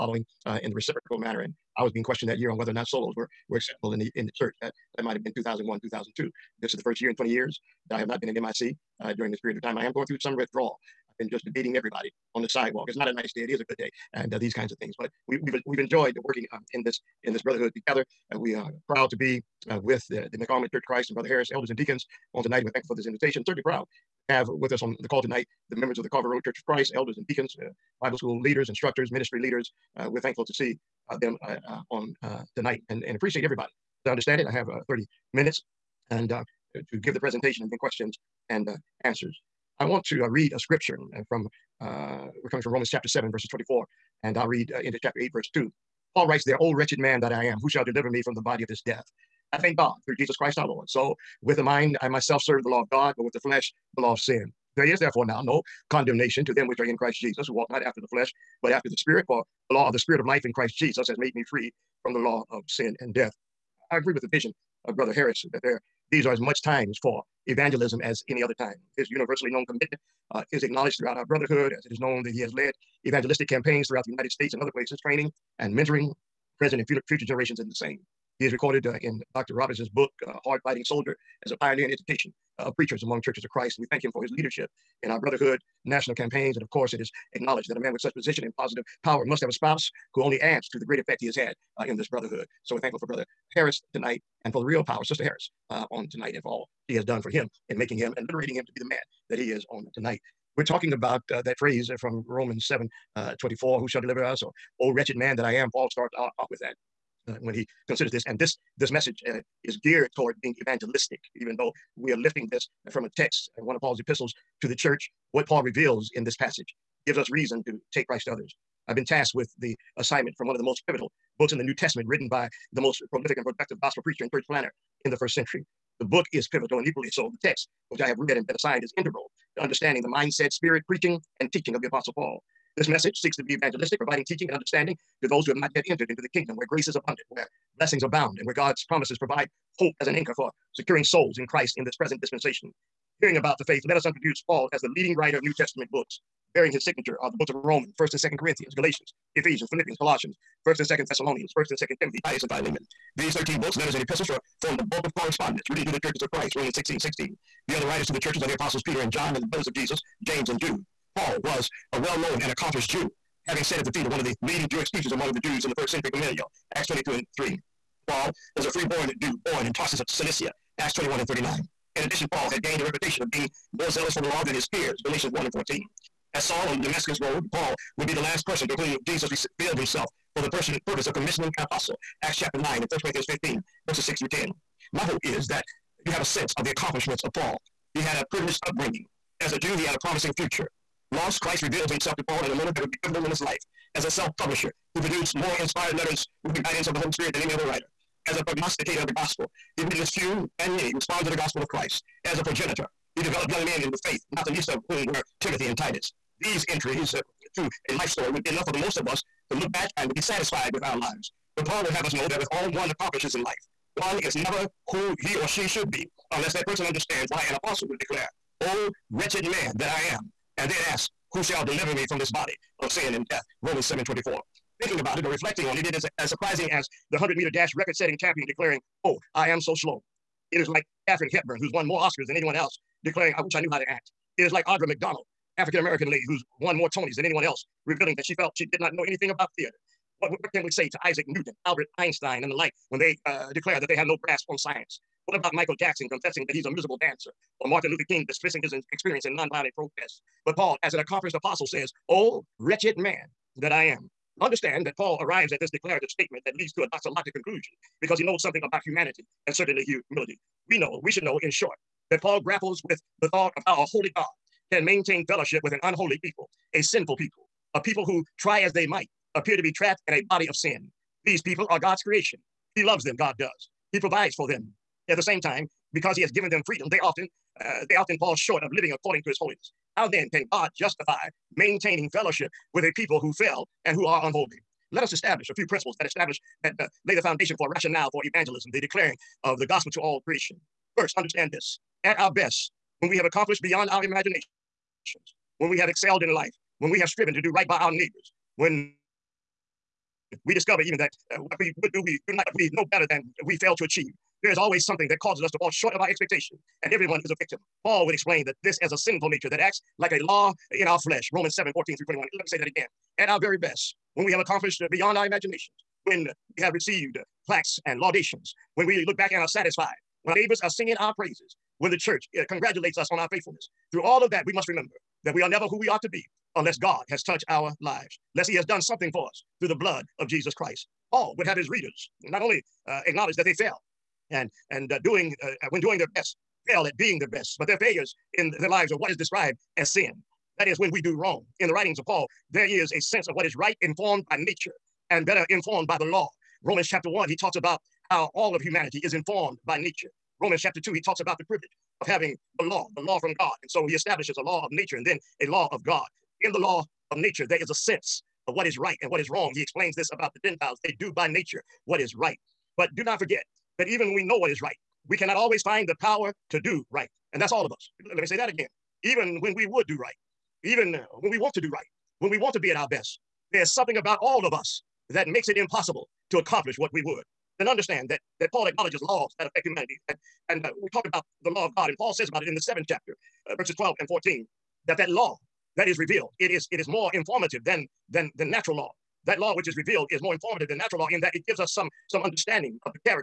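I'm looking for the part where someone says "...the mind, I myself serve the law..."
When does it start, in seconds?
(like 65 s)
51 s.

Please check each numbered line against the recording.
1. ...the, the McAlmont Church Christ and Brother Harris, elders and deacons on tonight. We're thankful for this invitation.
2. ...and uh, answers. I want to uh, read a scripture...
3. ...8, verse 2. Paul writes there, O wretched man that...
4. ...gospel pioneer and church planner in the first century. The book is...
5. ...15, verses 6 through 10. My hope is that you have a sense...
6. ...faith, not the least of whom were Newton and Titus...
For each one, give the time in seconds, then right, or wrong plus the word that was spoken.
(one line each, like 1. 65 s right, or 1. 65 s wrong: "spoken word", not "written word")
1. 20 s right
2. 38 s right
3. 45 s right
4. 123 s wrong: "preacher", not "pioneer"
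5. 183 s right
6. 204 s wrong: "Timothy", not "Newton".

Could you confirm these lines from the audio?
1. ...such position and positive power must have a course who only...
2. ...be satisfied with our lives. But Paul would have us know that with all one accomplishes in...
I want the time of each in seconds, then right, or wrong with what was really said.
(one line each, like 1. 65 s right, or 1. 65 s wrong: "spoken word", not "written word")
1. 87 s wrong: "spouse", not "course"
2. 210 s right.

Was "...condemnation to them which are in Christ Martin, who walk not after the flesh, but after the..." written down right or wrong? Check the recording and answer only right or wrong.
wrong.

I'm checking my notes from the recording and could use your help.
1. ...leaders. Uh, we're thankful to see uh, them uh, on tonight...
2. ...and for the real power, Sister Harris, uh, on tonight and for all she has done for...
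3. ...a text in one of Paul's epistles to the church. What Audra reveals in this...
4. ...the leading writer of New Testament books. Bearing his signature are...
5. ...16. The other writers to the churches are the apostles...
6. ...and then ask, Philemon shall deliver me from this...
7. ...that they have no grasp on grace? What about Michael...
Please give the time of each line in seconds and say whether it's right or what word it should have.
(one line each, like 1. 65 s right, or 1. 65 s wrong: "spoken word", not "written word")
1. 29 s right
2. 94 s right
3. 113 s wrong: "Paul", not "Audra"
4. 144 s right
5. 156 s right
6. 220 s wrong: "Who", not "Philemon"
7. 243 s wrong: "science", not "grace".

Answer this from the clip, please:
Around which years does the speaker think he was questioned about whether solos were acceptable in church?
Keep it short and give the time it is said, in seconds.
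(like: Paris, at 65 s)
2001, 2002, at 5 s.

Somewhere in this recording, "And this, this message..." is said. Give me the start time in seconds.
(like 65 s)
108 s.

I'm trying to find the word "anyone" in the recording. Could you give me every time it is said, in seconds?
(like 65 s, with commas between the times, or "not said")
232 s, 237 s.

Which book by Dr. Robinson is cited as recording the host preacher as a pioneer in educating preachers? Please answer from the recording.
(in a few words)
Hard Fighting Soldier.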